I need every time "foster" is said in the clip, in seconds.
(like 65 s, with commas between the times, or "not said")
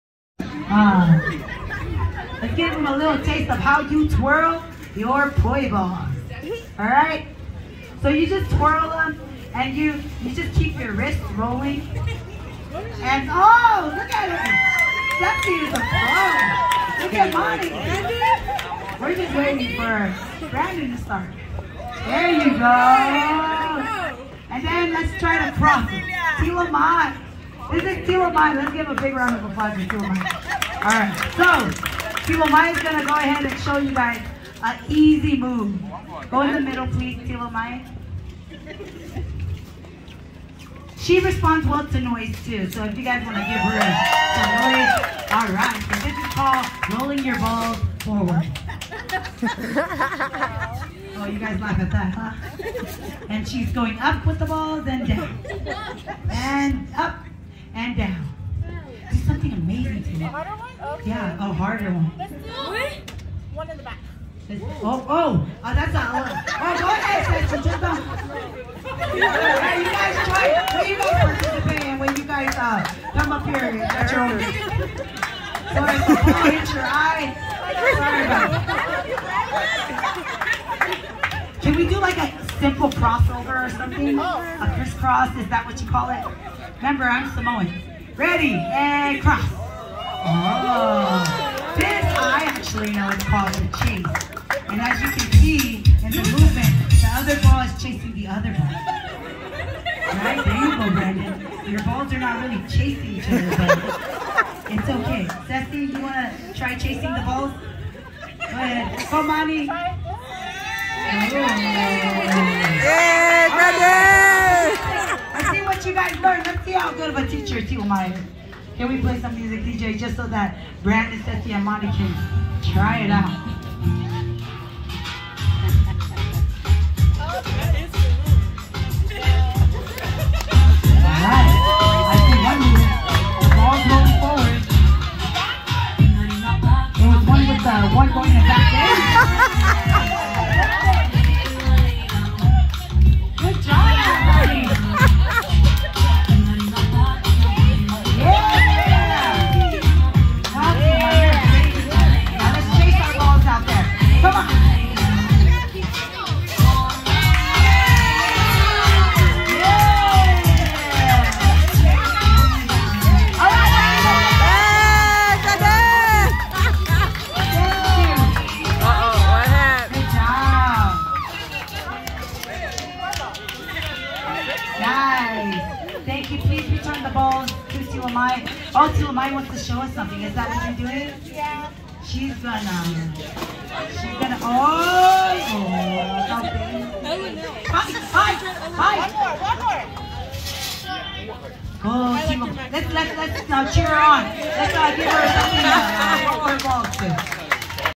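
not said.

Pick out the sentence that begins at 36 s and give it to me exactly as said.
Go in the middle, please, Tila Maya.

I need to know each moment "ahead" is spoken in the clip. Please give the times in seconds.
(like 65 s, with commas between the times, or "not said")
33 s, 66 s, 108 s.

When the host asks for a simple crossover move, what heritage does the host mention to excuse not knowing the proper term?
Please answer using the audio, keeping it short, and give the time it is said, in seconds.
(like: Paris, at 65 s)
Samoan, at 87 s.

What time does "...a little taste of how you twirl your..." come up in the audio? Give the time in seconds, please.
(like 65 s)
2 s.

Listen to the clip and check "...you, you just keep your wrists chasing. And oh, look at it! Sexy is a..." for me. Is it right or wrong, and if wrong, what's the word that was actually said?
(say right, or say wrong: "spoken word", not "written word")
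wrong: "rolling", not "chasing".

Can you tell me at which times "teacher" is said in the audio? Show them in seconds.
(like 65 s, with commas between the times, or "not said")
117 s.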